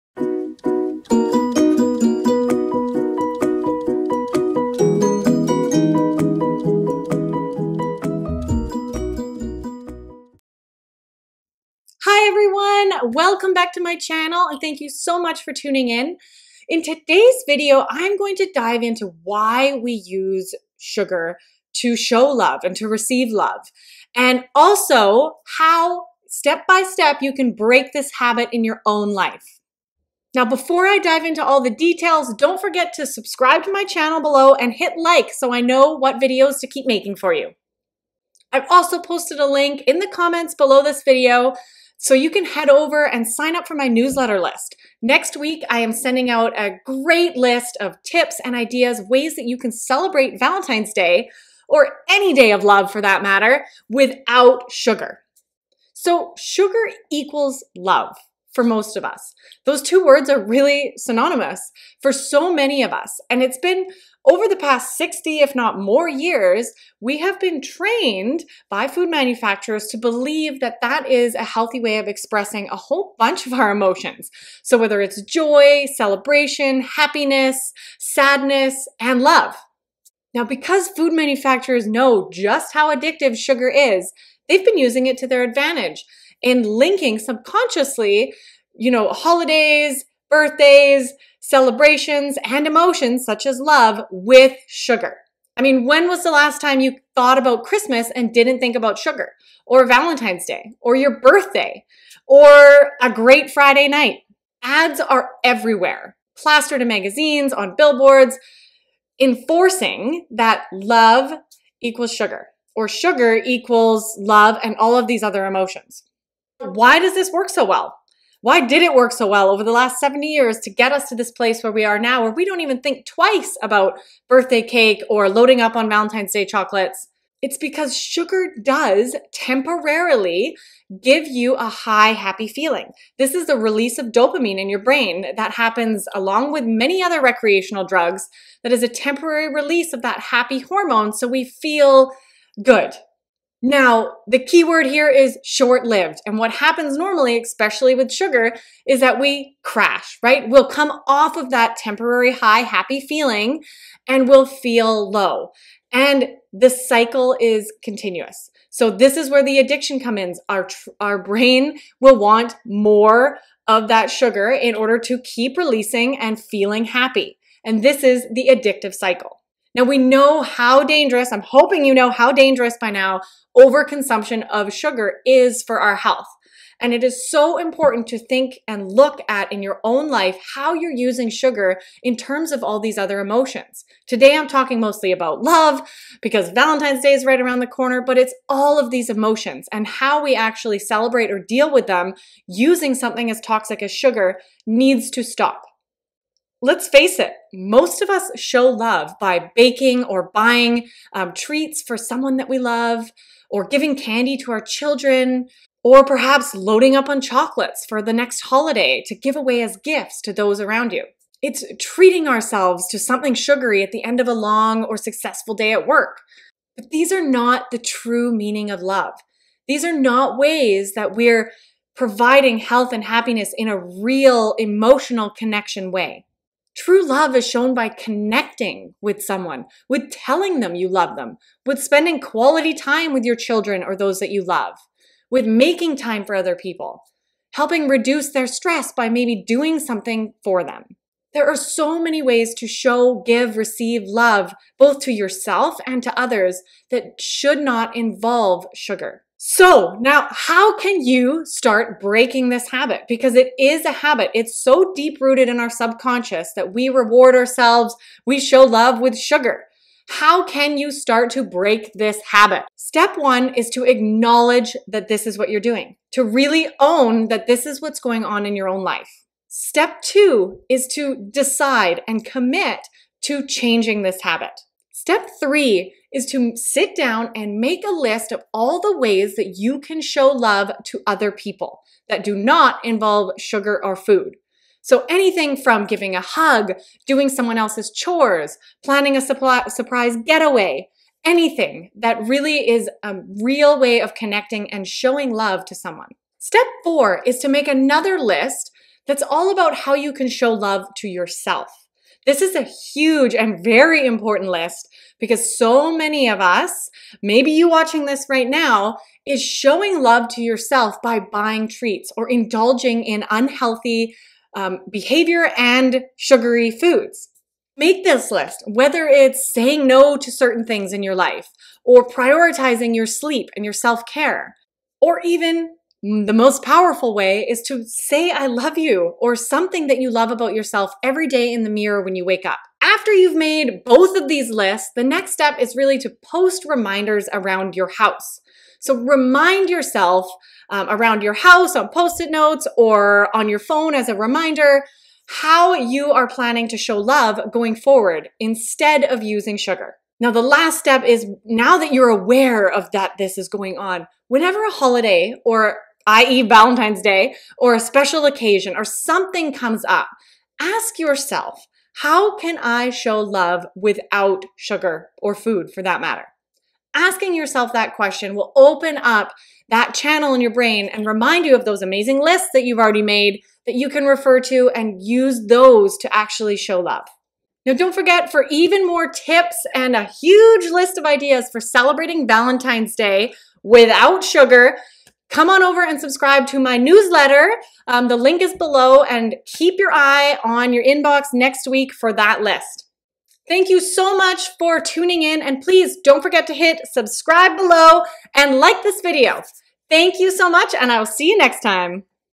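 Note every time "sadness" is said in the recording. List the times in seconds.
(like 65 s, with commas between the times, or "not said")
77 s.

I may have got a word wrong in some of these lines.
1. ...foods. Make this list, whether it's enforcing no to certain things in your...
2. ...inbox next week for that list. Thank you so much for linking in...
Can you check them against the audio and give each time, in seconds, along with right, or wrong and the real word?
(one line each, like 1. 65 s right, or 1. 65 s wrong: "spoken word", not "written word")
1. 316 s wrong: "saying", not "enforcing"
2. 390 s wrong: "tuning", not "linking".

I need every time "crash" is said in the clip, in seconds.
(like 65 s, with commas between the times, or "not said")
149 s.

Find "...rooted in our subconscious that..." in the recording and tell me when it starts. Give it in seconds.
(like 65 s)
255 s.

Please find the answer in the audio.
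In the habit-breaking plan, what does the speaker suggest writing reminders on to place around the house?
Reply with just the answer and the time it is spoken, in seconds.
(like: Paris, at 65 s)
post it notes, at 341 s.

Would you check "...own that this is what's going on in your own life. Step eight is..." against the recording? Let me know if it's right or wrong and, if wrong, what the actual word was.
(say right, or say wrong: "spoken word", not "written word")
wrong: "two", not "eight".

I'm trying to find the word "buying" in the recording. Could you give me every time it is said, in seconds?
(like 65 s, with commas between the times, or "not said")
200 s, 311 s.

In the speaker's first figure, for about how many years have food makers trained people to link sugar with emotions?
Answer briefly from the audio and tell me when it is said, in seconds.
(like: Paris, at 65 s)
60, at 64 s.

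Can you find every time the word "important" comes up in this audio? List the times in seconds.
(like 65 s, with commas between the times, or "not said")
177 s, 304 s.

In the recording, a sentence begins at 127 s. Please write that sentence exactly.
It's because sugar does temporarily give you a high, happy feeling.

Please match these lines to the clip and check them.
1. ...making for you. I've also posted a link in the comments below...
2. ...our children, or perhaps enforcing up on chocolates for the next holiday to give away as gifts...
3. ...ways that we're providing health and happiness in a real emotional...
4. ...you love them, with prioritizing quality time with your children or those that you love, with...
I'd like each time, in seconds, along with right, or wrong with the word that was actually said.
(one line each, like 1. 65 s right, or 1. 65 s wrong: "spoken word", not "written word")
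1. 36 s right
2. 204 s wrong: "loading", not "enforcing"
3. 220 s right
4. 230 s wrong: "spending", not "prioritizing".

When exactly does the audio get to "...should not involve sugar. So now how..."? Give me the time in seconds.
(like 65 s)
247 s.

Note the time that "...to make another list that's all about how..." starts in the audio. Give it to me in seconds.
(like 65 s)
297 s.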